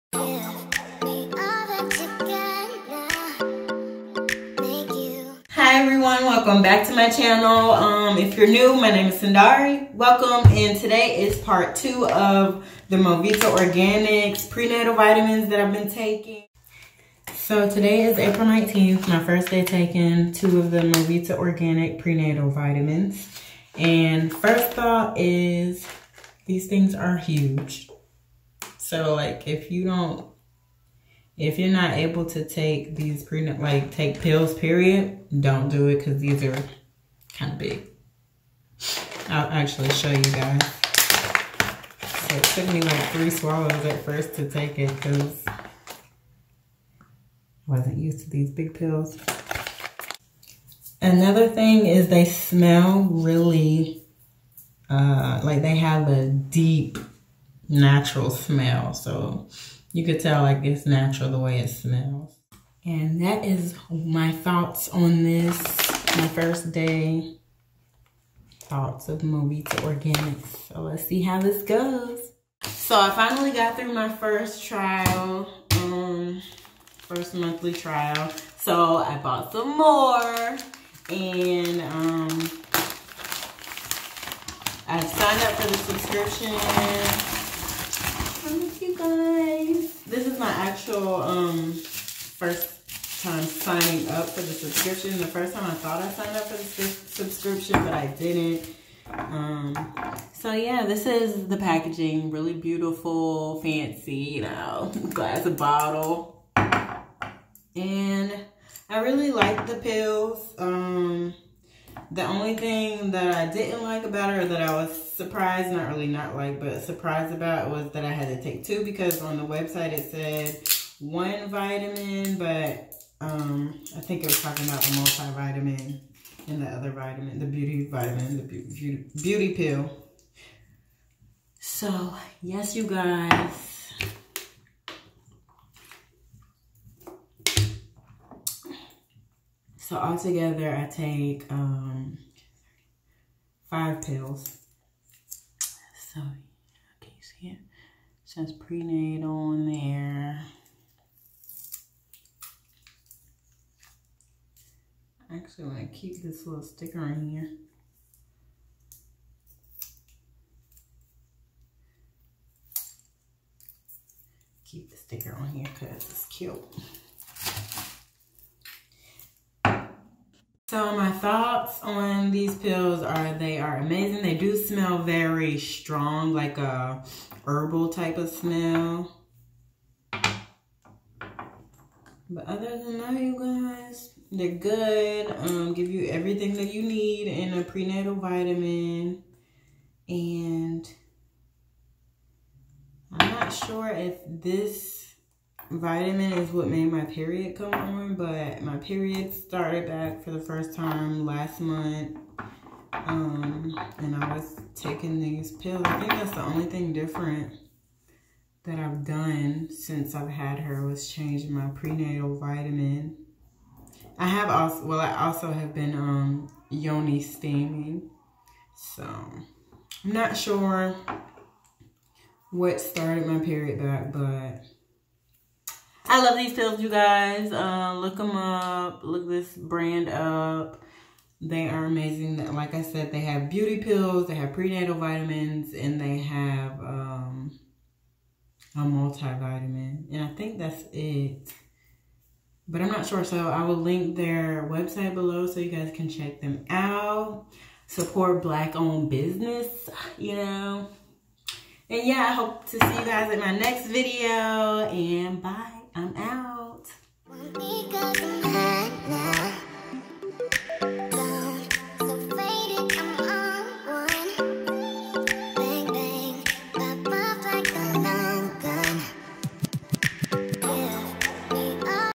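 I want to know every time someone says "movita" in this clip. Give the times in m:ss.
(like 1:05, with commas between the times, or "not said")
0:12, 0:20, 1:09.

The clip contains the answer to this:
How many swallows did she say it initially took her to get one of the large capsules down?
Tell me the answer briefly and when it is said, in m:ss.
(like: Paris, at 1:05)
3, at 0:43.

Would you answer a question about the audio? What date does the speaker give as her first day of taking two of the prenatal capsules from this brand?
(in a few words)
April 19th.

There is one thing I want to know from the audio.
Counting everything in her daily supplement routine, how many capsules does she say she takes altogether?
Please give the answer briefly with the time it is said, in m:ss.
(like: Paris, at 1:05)
5, at 2:23.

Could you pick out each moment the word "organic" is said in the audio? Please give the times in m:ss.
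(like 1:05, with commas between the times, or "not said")
0:13, 0:21, 1:09.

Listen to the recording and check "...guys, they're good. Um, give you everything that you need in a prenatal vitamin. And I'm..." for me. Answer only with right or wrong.
right.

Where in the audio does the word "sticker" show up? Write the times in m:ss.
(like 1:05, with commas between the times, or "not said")
2:36, 2:44.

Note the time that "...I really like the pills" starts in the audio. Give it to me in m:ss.
1:48.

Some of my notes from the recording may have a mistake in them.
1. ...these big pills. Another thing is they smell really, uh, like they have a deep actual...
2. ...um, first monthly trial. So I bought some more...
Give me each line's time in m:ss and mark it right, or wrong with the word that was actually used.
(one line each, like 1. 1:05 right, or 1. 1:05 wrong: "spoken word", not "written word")
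1. 0:48 wrong: "natural", not "actual"
2. 1:15 right.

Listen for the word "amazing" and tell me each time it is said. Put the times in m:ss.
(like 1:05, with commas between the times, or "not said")
2:53, 3:51.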